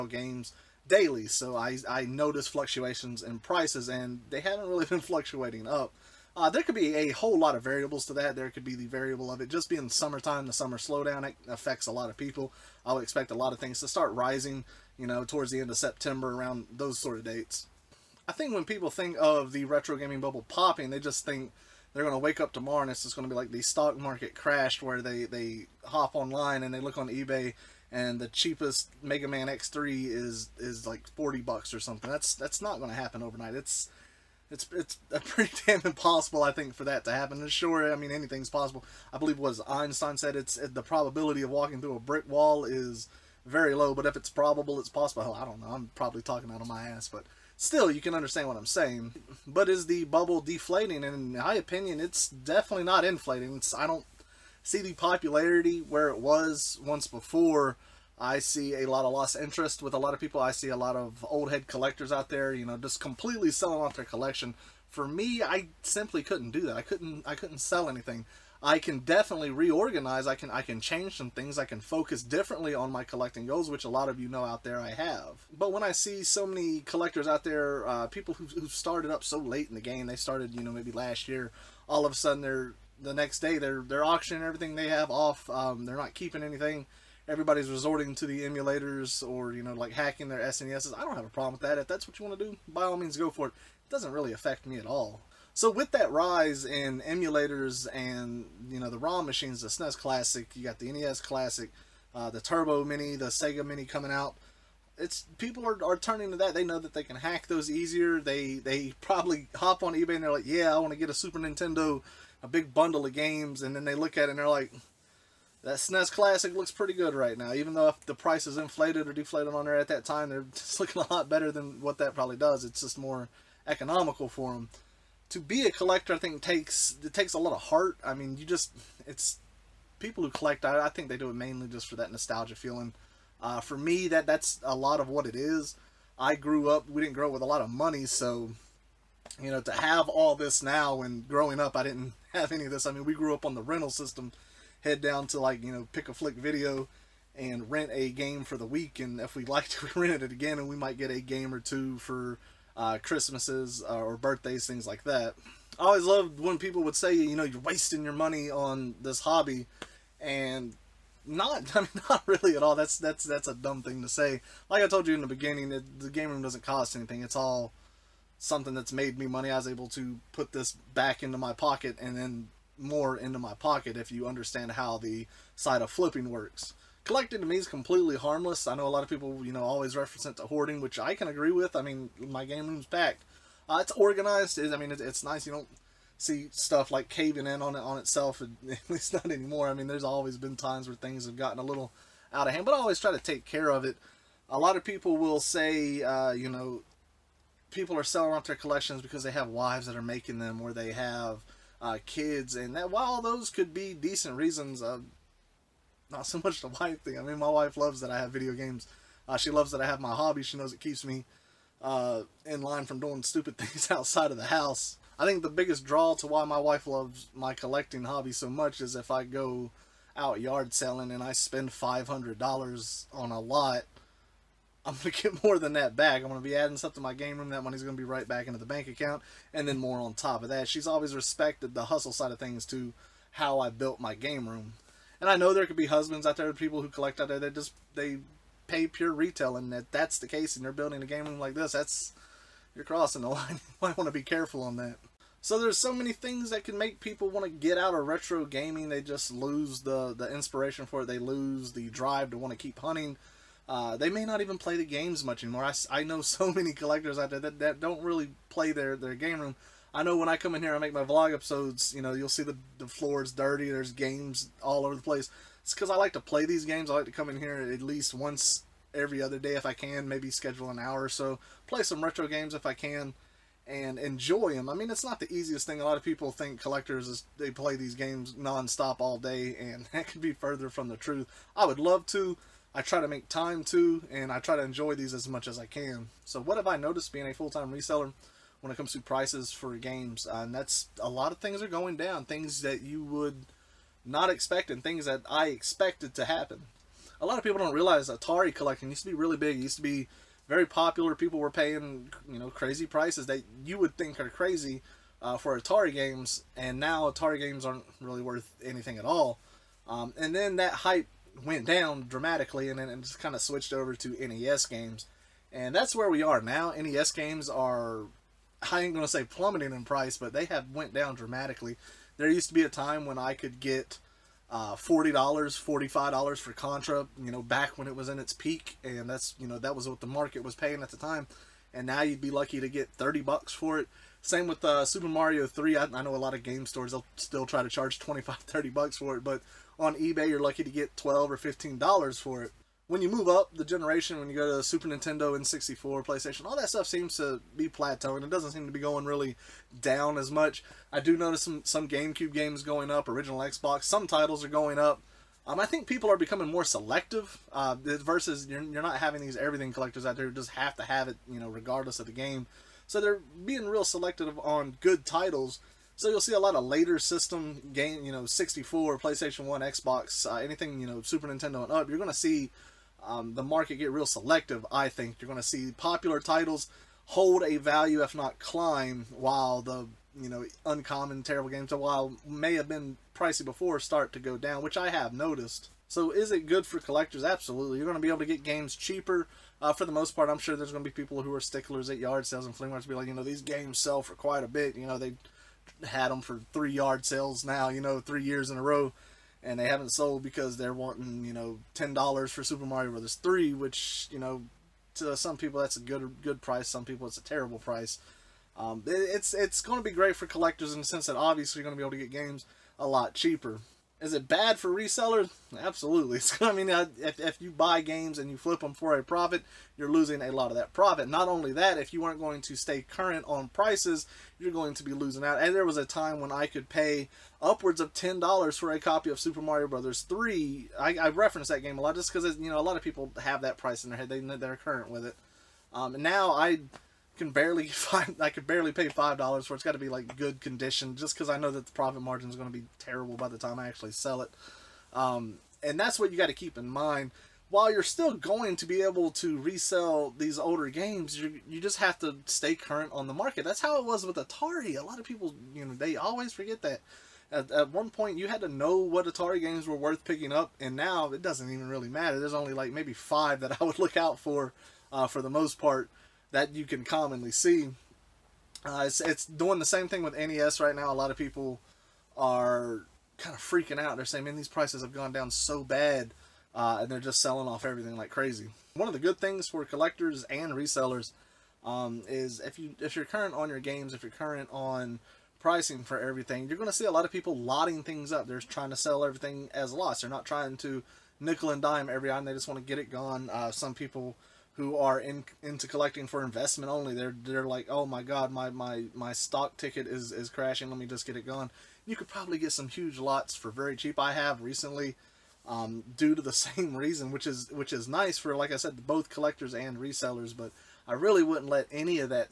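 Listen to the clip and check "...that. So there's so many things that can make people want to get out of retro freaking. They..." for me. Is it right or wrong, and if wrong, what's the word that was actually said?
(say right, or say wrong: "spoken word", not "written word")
wrong: "gaming", not "freaking".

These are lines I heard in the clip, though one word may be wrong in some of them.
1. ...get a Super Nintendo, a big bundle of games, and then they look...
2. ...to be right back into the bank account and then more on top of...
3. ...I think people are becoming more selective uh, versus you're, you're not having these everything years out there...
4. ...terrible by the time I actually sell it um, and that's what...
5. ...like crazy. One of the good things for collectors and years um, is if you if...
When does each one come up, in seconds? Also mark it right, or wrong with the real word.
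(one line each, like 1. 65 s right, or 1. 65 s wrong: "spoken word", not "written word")
1. 110 s right
2. 227 s right
3. 355 s wrong: "collectors", not "years"
4. 442 s right
5. 477 s wrong: "resellers", not "years".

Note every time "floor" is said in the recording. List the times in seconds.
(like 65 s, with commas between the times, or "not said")
262 s.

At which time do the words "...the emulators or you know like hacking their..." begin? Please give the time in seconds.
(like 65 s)
88 s.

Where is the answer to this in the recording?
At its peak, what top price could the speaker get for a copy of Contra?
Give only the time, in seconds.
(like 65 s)
325 s.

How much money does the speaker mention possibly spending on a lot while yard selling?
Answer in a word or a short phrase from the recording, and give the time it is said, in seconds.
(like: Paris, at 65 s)
$500, at 221 s.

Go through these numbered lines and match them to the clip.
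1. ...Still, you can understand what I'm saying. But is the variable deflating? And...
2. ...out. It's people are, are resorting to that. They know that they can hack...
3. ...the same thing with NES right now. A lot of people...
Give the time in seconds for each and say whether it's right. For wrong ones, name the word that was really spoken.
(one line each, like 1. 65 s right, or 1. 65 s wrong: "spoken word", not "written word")
1. 47 s wrong: "bubble", not "variable"
2. 104 s wrong: "turning", not "resorting"
3. 469 s right.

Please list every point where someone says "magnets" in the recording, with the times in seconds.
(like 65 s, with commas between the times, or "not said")
not said.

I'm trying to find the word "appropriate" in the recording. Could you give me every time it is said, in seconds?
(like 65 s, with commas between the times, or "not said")
not said.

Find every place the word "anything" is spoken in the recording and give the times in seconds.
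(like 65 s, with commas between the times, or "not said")
38 s, 67 s, 86 s, 166 s, 308 s, 370 s.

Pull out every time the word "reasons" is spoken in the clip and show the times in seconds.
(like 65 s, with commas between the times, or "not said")
204 s, 506 s.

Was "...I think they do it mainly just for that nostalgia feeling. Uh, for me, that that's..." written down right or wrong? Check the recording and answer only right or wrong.
right.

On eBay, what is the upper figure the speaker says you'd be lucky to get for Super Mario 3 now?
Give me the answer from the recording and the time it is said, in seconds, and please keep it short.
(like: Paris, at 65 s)
$15, at 341 s.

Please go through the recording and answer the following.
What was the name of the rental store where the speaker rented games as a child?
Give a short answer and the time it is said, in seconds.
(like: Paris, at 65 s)
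Pick a Flick Video, at 145 s.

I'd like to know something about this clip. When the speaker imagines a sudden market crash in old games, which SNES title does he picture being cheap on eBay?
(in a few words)
Mega Man X3.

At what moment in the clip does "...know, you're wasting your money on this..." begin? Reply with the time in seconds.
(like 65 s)
157 s.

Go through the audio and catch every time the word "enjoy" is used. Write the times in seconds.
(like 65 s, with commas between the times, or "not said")
273 s, 284 s.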